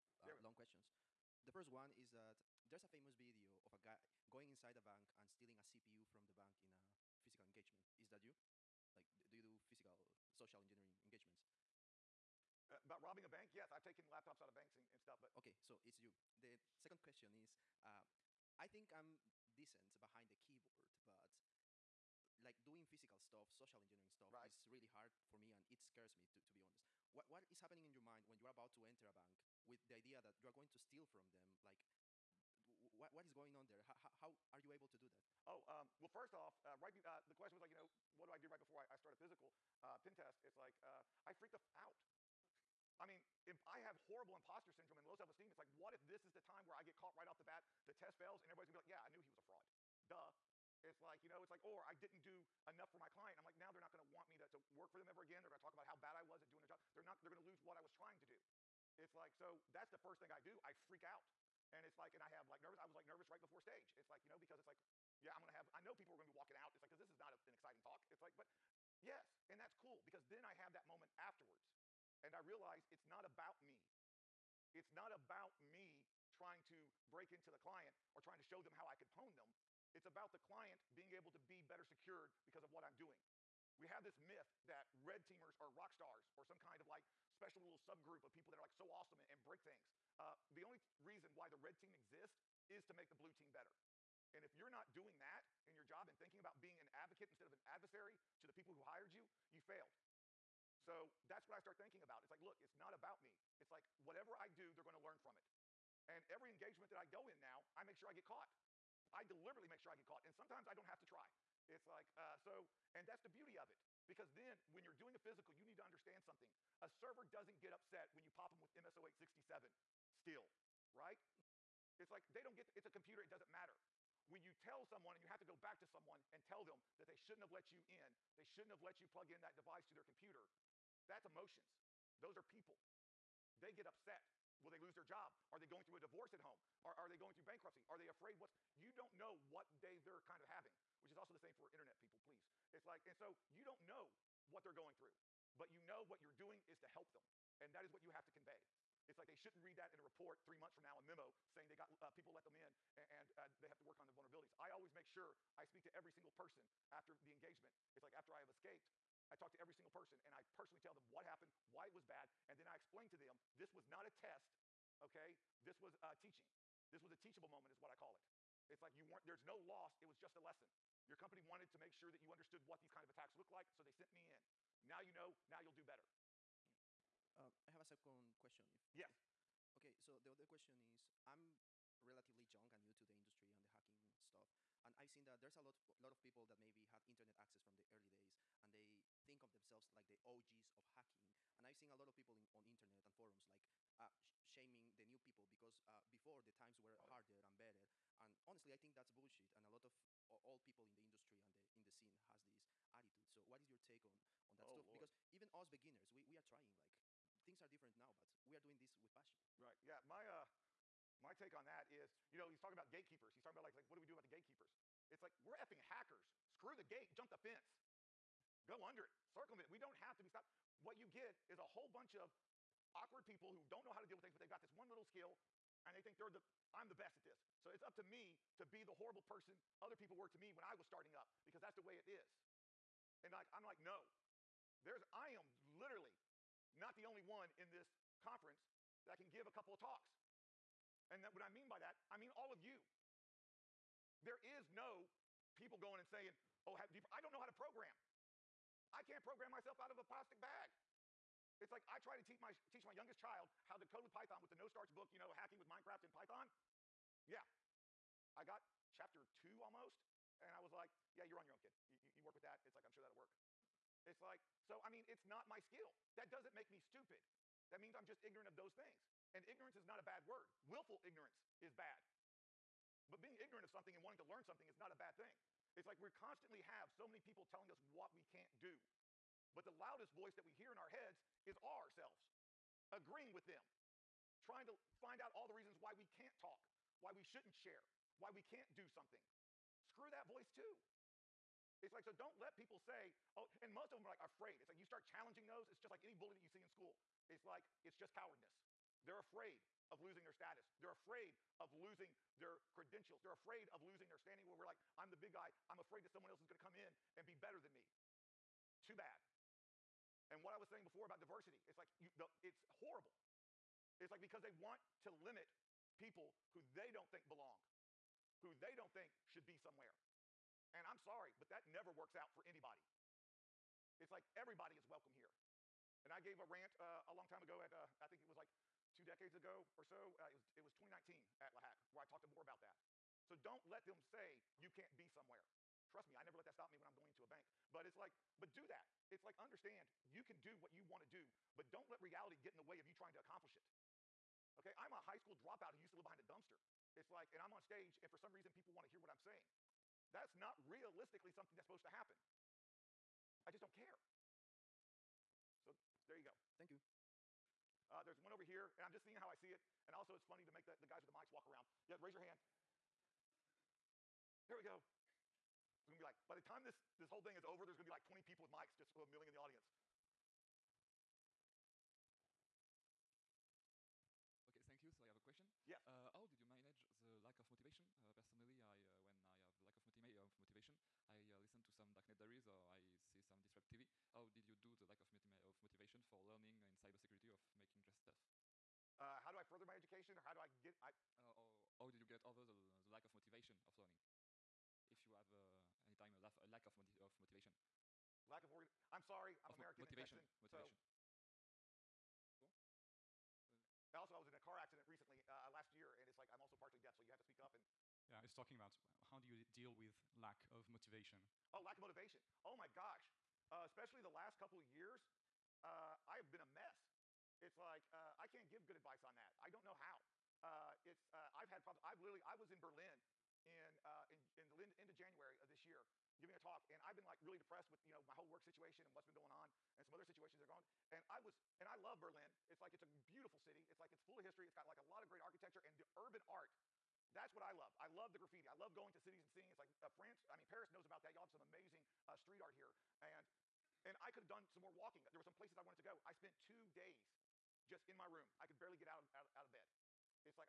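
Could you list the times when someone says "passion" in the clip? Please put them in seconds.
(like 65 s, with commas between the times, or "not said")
209 s.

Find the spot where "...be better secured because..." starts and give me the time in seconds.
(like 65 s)
81 s.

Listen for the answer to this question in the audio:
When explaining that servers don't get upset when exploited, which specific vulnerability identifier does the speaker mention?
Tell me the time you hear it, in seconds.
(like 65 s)
118 s.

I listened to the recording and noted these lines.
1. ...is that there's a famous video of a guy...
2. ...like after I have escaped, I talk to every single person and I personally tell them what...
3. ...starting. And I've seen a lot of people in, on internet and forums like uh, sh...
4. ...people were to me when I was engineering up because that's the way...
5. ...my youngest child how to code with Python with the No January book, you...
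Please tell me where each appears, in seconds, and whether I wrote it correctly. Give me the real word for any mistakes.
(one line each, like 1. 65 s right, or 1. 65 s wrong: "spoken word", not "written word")
1. 1 s right
2. 158 s right
3. 190 s wrong: "hacking", not "starting"
4. 229 s wrong: "starting", not "engineering"
5. 252 s wrong: "Starch", not "January".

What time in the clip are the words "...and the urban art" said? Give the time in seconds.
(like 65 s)
435 s.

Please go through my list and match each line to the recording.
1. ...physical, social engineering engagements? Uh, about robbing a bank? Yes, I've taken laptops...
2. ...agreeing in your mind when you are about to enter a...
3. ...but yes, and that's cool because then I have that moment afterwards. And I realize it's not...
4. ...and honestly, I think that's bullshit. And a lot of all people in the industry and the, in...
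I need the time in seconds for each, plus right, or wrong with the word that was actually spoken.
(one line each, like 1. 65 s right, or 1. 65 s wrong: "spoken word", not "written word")
1. 9 s right
2. 27 s wrong: "happening", not "agreeing"
3. 68 s right
4. 198 s right.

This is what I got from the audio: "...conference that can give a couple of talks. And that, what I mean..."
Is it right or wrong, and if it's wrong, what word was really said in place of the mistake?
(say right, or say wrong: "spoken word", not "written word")
right.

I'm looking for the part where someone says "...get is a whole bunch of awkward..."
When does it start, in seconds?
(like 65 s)
221 s.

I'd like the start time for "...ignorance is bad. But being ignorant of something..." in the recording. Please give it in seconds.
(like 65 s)
271 s.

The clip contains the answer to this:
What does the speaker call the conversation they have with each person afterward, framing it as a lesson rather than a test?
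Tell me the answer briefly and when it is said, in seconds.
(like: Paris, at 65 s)
a teachable moment, at 167 s.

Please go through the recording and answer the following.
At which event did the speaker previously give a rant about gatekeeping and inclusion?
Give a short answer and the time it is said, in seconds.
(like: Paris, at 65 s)
leHACK, at 331 s.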